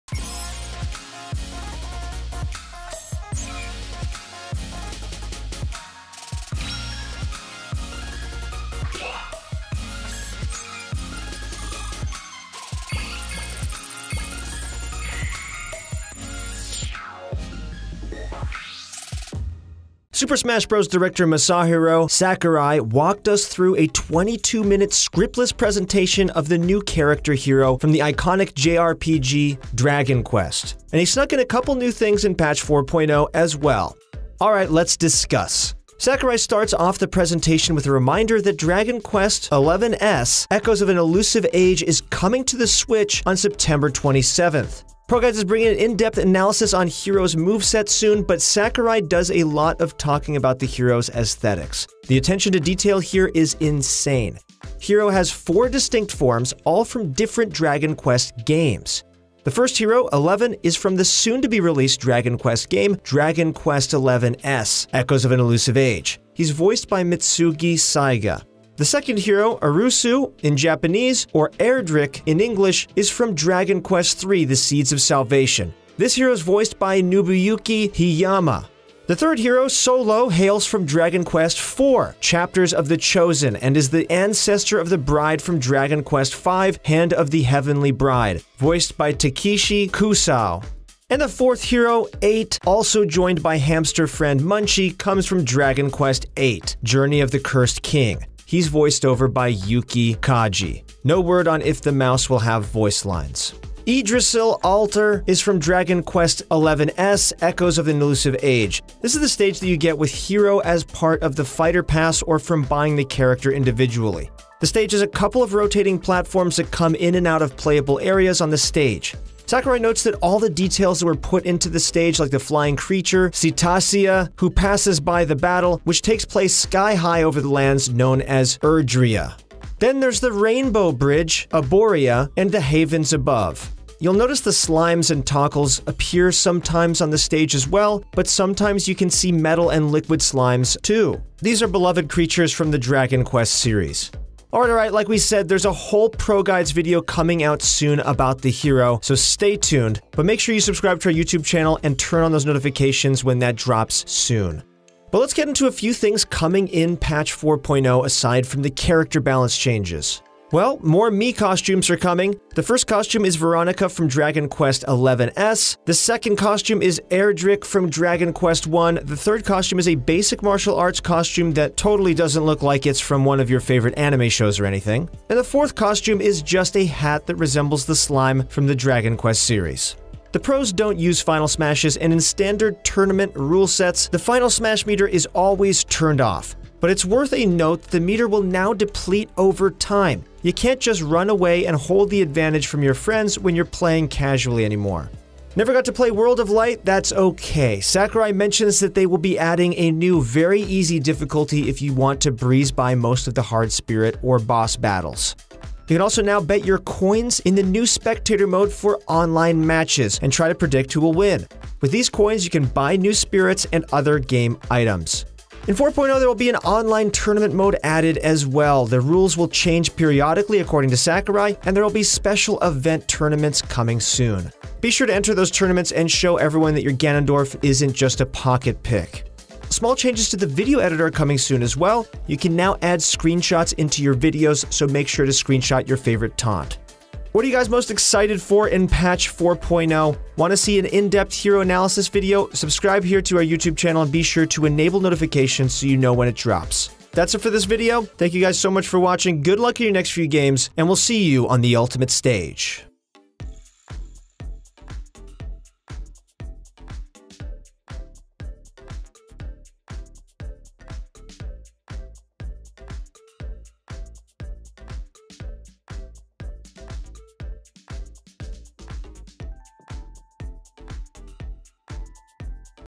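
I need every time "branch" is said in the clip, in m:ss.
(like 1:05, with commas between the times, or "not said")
not said.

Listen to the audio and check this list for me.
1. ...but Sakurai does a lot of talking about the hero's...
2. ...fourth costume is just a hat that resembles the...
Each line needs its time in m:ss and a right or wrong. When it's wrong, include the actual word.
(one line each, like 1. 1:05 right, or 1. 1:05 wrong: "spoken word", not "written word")
1. 0:48 right
2. 2:55 right.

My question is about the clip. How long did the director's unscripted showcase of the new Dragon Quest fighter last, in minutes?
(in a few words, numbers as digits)
22 minutes.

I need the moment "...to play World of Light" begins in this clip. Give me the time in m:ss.
3:15.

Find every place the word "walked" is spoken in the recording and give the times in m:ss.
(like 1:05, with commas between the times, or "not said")
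0:22.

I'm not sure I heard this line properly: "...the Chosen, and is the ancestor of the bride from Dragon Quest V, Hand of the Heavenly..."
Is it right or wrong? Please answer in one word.
right.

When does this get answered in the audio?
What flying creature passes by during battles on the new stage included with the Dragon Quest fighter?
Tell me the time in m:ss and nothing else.
2:03.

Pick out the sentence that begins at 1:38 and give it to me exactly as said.
He's voiced over by Yuki Kaji.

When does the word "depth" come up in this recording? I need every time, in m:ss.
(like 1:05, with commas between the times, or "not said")
0:45, 4:00.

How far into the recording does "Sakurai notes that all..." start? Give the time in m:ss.
1:59.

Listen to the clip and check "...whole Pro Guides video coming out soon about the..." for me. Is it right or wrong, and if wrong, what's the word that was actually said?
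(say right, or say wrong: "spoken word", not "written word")
right.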